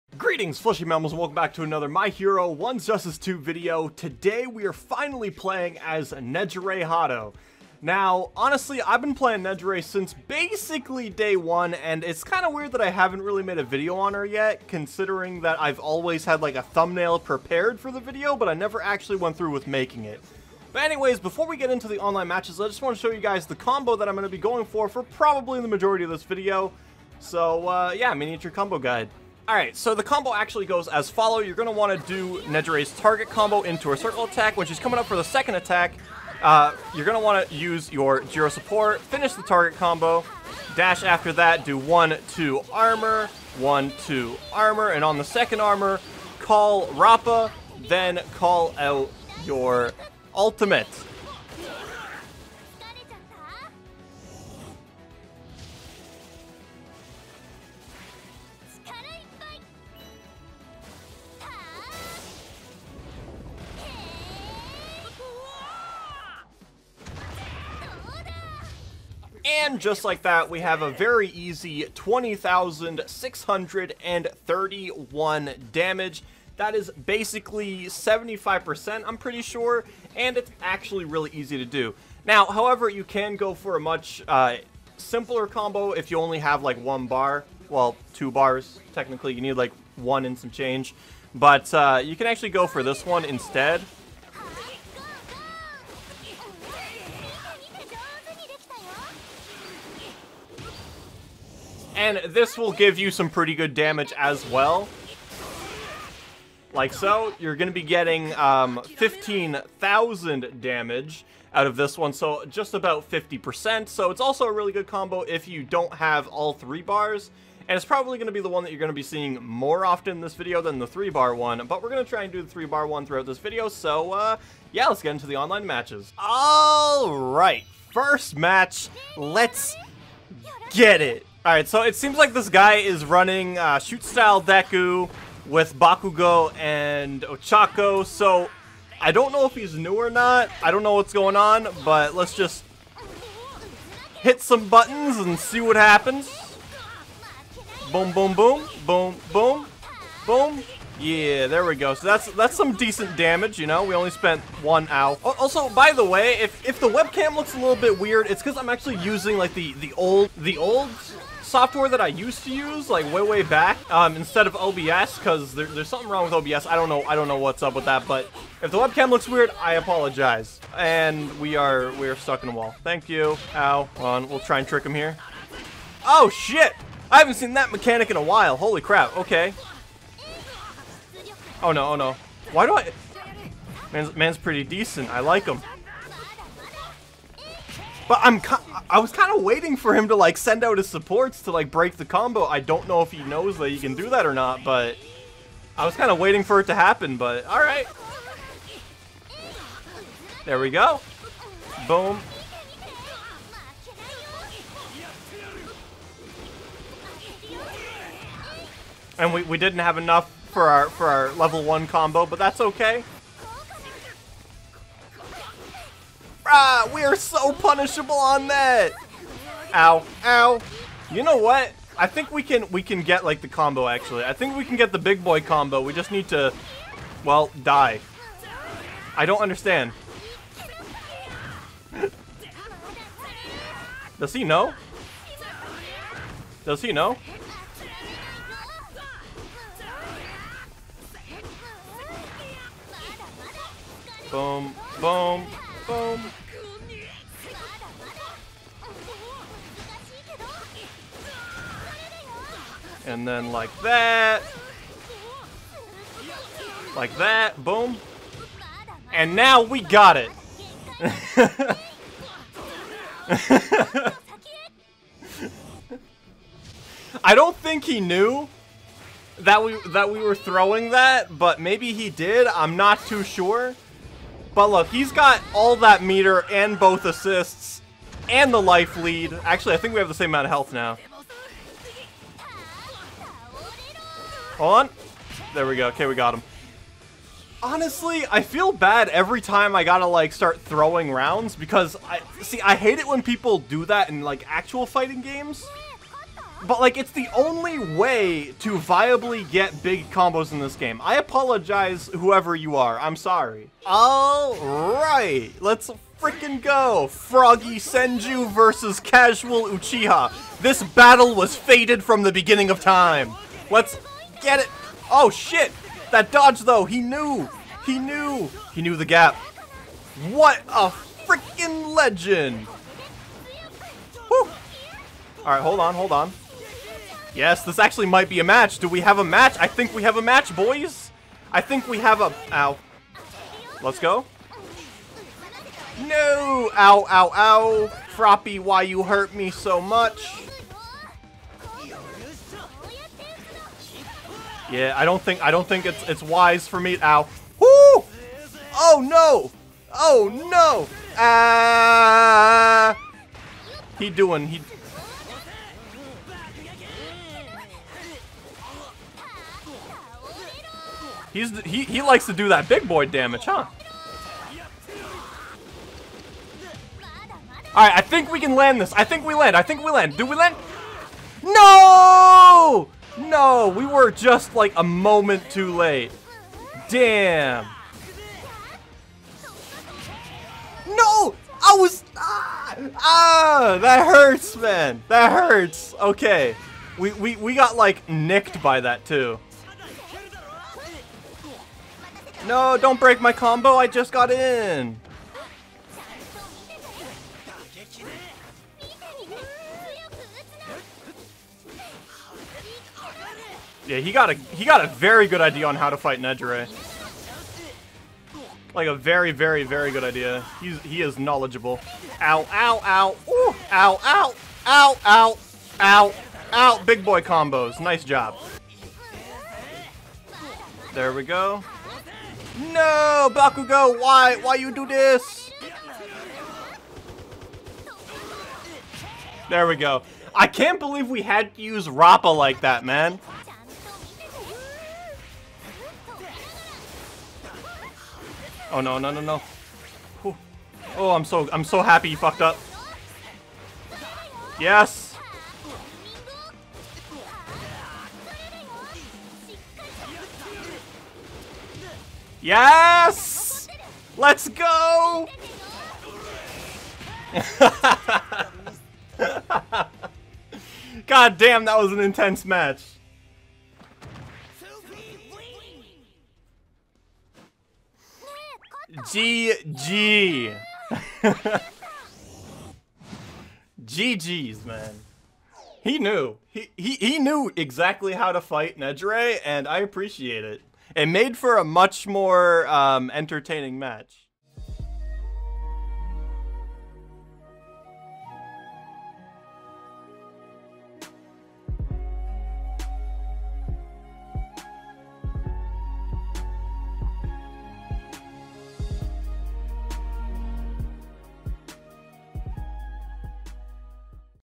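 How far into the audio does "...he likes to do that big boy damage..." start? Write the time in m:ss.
6:01.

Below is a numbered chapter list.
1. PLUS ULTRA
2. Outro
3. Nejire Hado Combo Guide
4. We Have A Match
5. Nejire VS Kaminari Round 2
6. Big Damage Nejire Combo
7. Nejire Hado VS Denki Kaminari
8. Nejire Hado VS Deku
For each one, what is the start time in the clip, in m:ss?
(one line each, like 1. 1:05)
1. 7:25
2. 8:04
3. 0:29
4. 5:15
5. 6:24
6. 4:01
7. 5:04
8. 2:06.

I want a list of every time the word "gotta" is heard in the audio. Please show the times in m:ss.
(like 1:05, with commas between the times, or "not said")
4:49.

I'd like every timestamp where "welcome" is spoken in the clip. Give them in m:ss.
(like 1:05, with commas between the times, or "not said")
0:01.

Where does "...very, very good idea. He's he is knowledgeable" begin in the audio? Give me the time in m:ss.
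6:49.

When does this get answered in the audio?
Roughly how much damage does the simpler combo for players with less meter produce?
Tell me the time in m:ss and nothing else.
1:48.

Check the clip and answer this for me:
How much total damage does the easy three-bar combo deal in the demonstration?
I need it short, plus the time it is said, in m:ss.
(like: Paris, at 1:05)
20,631, at 1:11.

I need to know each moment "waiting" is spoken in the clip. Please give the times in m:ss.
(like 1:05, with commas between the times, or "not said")
3:09, 3:16.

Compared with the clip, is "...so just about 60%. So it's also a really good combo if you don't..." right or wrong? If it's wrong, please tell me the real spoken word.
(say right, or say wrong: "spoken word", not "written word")
wrong: "50", not "60".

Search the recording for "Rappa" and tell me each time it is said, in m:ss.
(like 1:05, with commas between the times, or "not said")
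0:46, 7:11.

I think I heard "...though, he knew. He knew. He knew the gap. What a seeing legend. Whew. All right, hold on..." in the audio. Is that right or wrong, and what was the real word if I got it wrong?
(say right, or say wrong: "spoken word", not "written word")
wrong: "freaking", not "seeing".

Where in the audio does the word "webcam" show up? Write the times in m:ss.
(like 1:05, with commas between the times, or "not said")
2:36, 2:48.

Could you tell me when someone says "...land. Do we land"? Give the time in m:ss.
6:09.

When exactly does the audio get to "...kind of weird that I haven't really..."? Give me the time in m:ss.
0:12.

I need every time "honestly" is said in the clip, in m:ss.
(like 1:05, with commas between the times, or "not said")
0:08, 4:47.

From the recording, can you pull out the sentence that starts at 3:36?
Ah, we are so punishable on that.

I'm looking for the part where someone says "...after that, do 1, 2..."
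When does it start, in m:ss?
0:41.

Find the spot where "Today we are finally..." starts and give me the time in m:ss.
0:03.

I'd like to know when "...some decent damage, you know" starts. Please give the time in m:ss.
2:32.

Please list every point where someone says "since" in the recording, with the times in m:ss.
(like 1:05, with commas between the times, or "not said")
0:09.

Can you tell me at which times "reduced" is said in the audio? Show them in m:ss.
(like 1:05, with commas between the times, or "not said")
not said.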